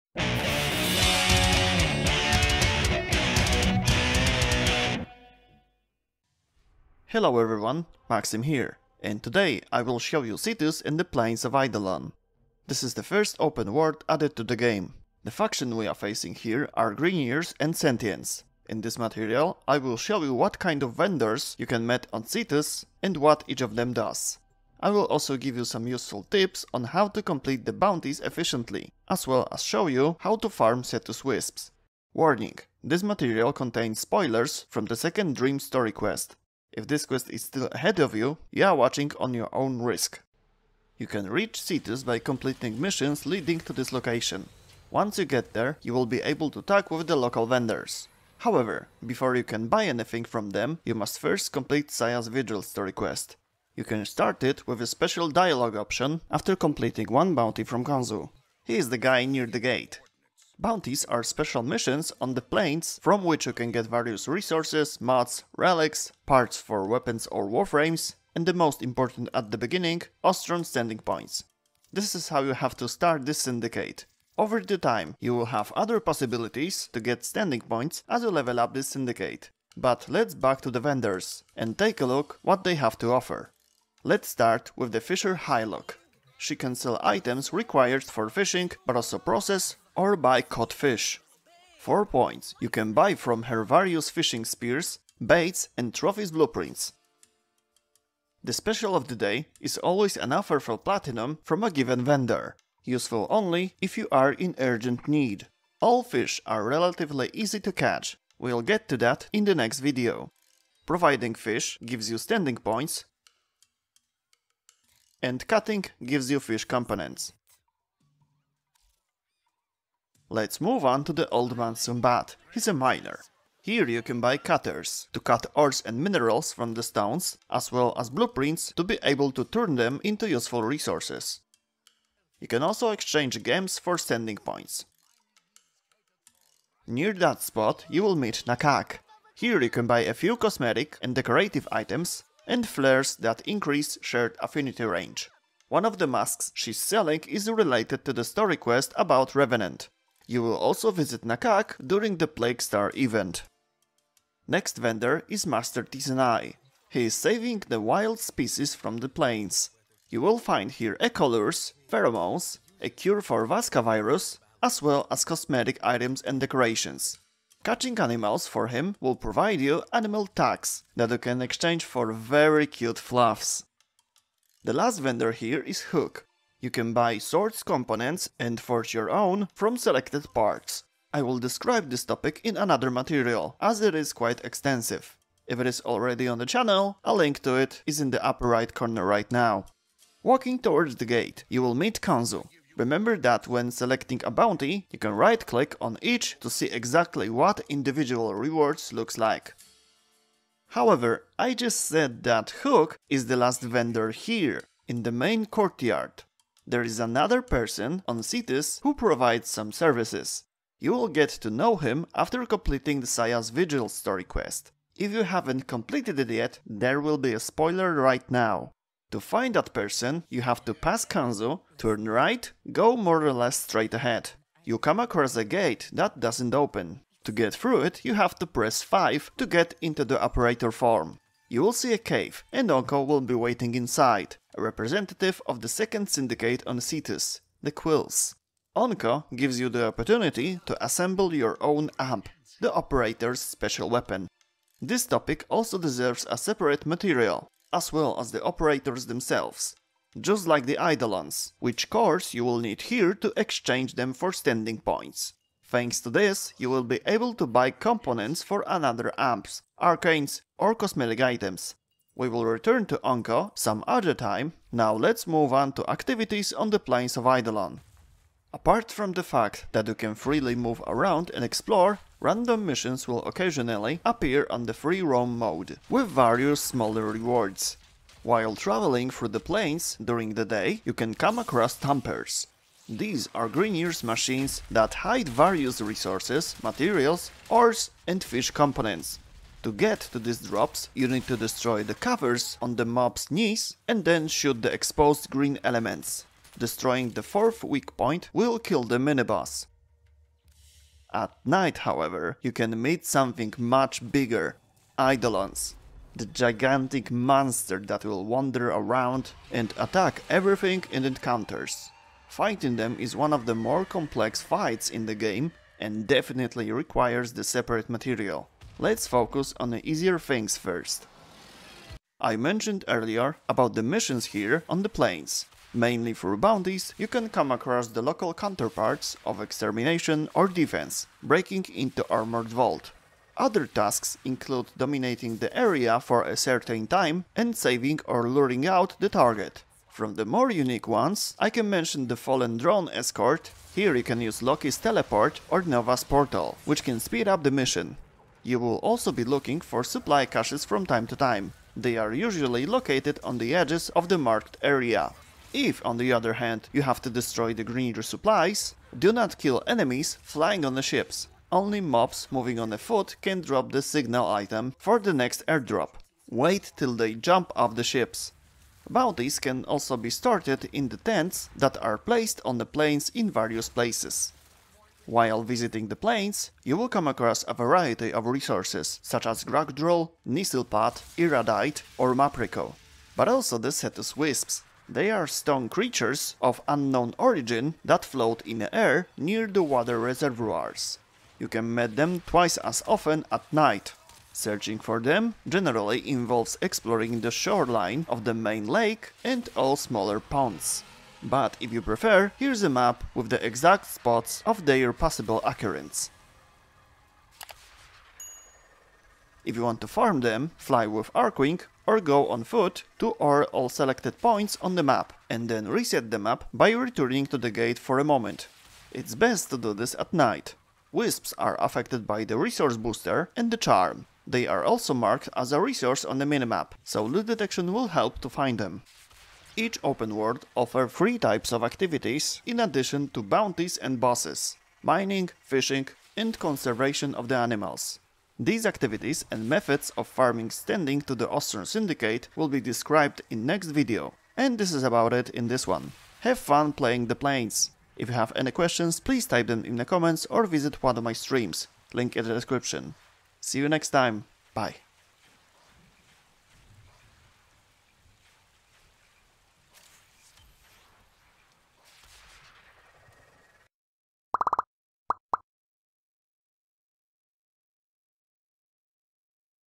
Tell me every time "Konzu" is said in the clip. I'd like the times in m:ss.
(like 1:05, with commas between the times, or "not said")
0:57, 3:12, 3:41.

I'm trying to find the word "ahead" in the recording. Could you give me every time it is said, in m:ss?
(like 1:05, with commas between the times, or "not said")
0:37, 3:43.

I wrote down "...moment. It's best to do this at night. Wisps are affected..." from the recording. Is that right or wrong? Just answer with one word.
right.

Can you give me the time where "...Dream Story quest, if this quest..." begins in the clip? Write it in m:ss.
0:35.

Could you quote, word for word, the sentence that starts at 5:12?
Fighting them is one of the more complex fights in the game and definitely requires the separate material.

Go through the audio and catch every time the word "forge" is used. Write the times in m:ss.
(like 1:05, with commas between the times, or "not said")
2:58.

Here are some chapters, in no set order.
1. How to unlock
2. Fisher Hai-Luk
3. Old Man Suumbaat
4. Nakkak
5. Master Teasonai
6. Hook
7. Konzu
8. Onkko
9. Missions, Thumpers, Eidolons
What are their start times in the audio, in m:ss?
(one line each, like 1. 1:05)
1. 0:32
2. 1:24
3. 1:59
4. 2:16
5. 2:34
6. 2:54
7. 3:10
8. 3:26
9. 4:24.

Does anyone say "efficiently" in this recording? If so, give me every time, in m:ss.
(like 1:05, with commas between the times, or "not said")
0:28.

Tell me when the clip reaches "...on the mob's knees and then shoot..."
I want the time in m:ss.
4:52.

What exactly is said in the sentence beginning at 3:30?
You will get to know him after completing the Saya's Vigil story quest.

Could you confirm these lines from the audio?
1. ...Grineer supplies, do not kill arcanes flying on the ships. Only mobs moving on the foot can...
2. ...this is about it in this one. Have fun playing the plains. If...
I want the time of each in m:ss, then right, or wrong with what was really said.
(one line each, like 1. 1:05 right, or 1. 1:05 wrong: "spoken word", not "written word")
1. 5:57 wrong: "enemies", not "arcanes"
2. 7:24 right.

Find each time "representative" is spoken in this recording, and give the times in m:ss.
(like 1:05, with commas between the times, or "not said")
3:54.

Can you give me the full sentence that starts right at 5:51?
They are usually located on the edges of the marked area.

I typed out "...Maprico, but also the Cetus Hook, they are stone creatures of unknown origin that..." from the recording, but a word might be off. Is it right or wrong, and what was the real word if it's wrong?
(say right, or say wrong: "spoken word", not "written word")
wrong: "Wisps", not "Hook".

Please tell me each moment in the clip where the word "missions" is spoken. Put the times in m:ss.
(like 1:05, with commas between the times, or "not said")
0:42, 1:01, 4:32, 5:23, 5:47.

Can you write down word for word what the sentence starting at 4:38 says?
While traveling through the plains during the day, you can come across Thumpers.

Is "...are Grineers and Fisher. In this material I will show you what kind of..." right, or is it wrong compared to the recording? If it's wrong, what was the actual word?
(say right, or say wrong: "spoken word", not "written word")
wrong: "Sentients", not "Fisher".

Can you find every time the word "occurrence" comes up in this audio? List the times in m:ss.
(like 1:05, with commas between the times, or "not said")
6:45.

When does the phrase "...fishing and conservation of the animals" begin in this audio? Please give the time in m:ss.
7:15.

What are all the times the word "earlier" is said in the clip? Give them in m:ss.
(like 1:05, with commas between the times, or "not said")
5:22.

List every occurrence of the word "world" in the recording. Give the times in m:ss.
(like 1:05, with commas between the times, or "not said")
0:13, 7:10.